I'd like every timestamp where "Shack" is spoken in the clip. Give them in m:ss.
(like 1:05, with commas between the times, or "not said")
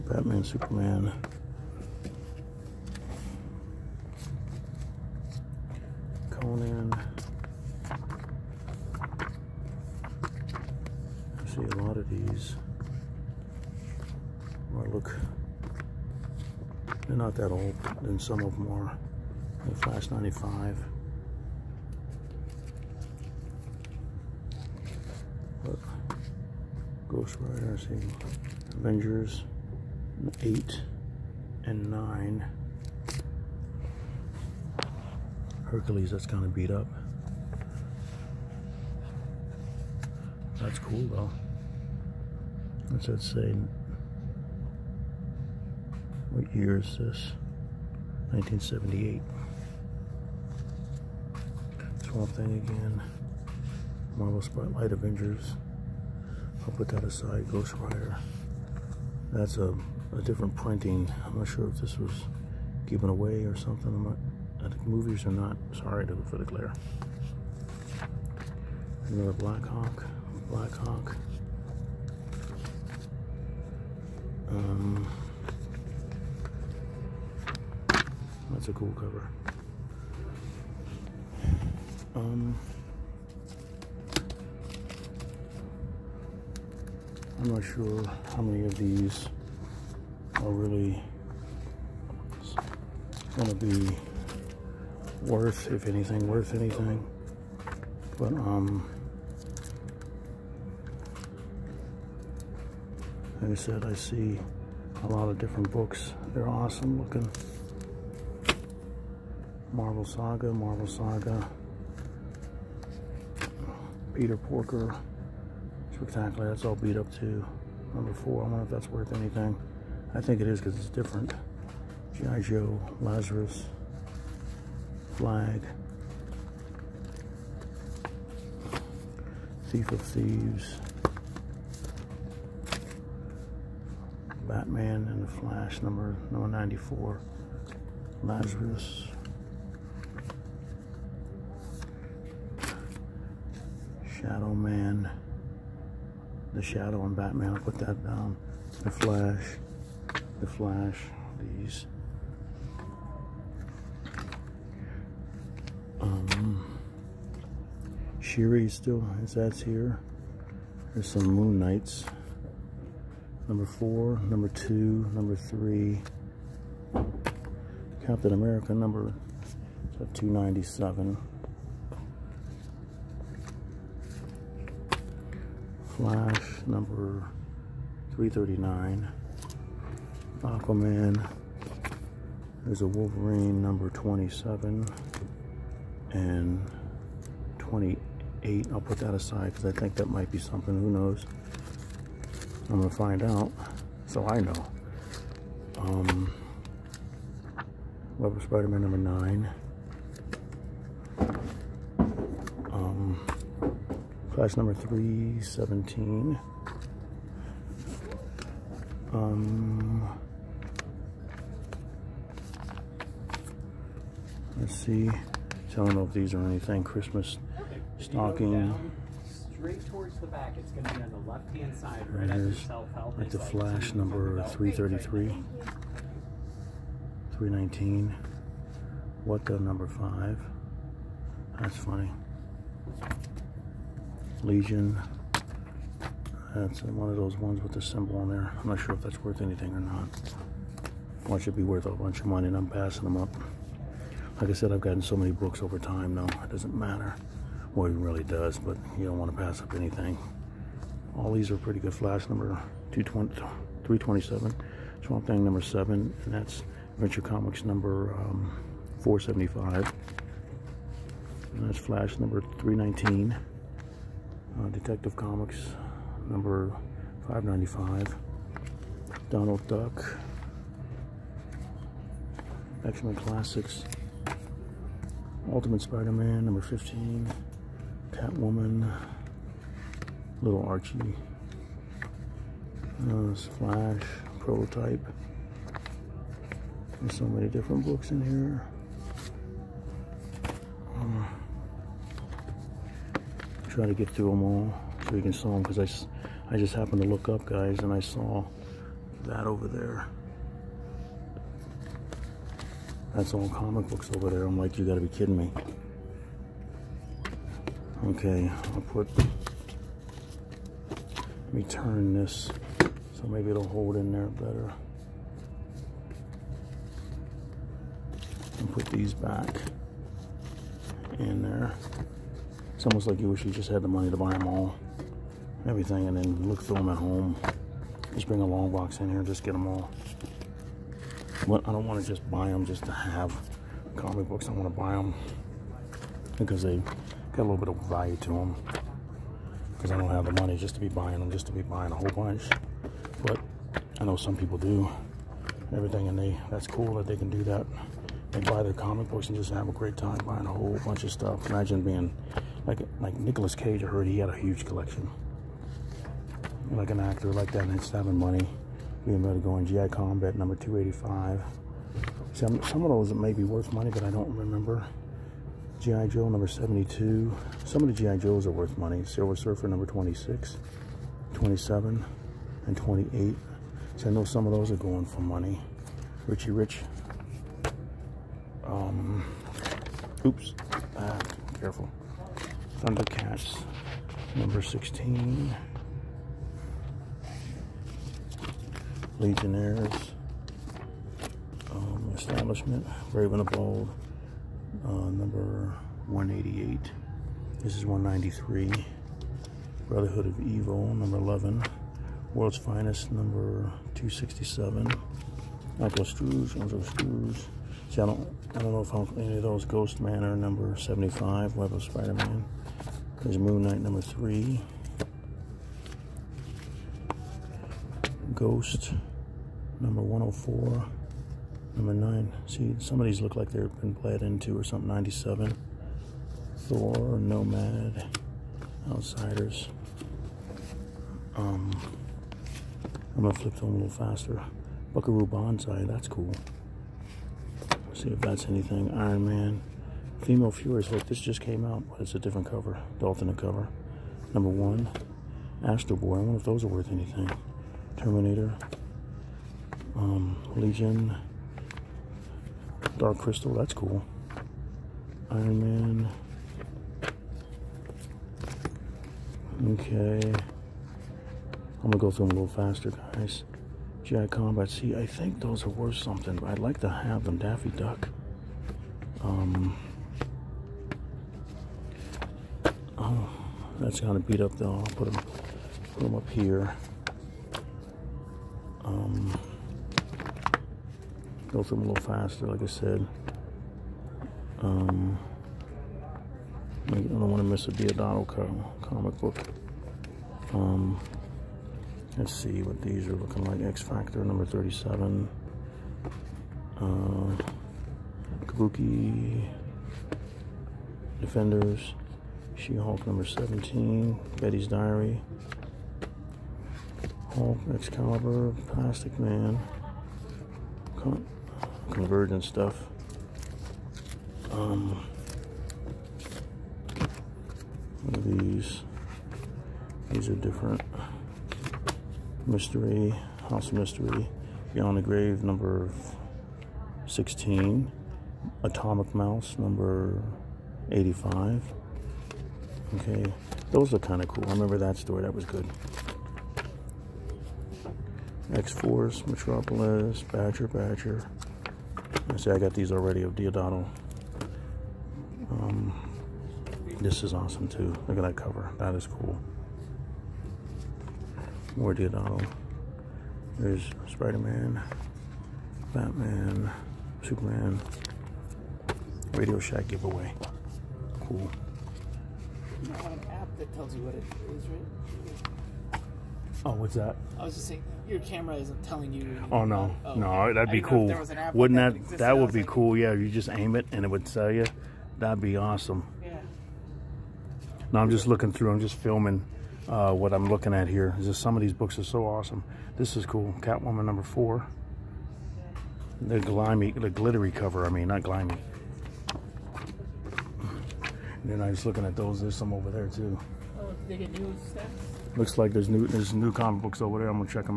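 9:19.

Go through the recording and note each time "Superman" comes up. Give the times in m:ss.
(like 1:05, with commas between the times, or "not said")
0:00, 9:17.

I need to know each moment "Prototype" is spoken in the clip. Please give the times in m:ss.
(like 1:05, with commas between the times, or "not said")
4:44.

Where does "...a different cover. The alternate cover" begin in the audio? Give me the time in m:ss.
7:22.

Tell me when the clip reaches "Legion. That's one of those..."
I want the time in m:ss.
3:54.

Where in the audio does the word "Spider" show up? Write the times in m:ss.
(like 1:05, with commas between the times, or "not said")
3:18, 4:35, 6:51, 9:14.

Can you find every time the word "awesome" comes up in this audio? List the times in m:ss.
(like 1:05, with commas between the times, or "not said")
1:46, 9:07, 9:35, 9:42.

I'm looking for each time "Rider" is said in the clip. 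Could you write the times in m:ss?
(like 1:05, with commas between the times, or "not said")
0:27, 0:57.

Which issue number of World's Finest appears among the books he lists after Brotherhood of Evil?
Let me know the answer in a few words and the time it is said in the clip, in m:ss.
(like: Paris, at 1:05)
267, at 6:43.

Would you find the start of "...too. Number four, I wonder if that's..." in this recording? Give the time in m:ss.
1:57.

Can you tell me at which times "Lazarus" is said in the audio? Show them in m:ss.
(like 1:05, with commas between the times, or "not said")
2:03, 2:18.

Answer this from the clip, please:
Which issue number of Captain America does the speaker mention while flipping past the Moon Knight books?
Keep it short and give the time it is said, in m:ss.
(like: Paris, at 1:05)
297, at 2:48.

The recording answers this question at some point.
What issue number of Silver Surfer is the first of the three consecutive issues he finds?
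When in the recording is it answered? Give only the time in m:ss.
6:09.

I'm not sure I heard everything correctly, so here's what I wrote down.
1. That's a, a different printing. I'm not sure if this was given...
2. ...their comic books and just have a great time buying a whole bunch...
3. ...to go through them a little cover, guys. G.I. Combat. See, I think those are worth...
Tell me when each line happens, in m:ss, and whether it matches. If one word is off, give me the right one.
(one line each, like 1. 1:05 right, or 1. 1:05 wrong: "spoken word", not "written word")
1. 0:59 right
2. 5:48 right
3. 7:41 wrong: "faster", not "cover".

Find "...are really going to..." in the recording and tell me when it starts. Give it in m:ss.
1:30.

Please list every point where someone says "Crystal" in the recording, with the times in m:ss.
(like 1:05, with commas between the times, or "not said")
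7:33.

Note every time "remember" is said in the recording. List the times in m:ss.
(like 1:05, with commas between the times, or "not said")
6:04, 8:54.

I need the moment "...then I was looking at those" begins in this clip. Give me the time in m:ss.
9:51.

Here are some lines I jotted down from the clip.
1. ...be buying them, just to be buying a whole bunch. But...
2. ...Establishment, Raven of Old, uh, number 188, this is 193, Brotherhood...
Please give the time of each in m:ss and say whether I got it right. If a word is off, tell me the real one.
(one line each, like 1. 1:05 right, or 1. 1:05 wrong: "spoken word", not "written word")
1. 5:40 right
2. 6:32 right.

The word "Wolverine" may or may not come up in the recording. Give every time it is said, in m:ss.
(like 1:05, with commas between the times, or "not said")
3:02.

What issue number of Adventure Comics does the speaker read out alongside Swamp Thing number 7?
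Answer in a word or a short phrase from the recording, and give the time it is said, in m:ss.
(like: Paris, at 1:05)
475, at 4:18.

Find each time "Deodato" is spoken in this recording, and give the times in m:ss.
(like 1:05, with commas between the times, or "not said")
8:07, 9:03, 9:11.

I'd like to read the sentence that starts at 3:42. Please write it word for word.
Right here's like the flash number 333.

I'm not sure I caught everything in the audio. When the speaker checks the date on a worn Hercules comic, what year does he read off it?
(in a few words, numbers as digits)
1978.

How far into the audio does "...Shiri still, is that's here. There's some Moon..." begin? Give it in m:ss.
2:38.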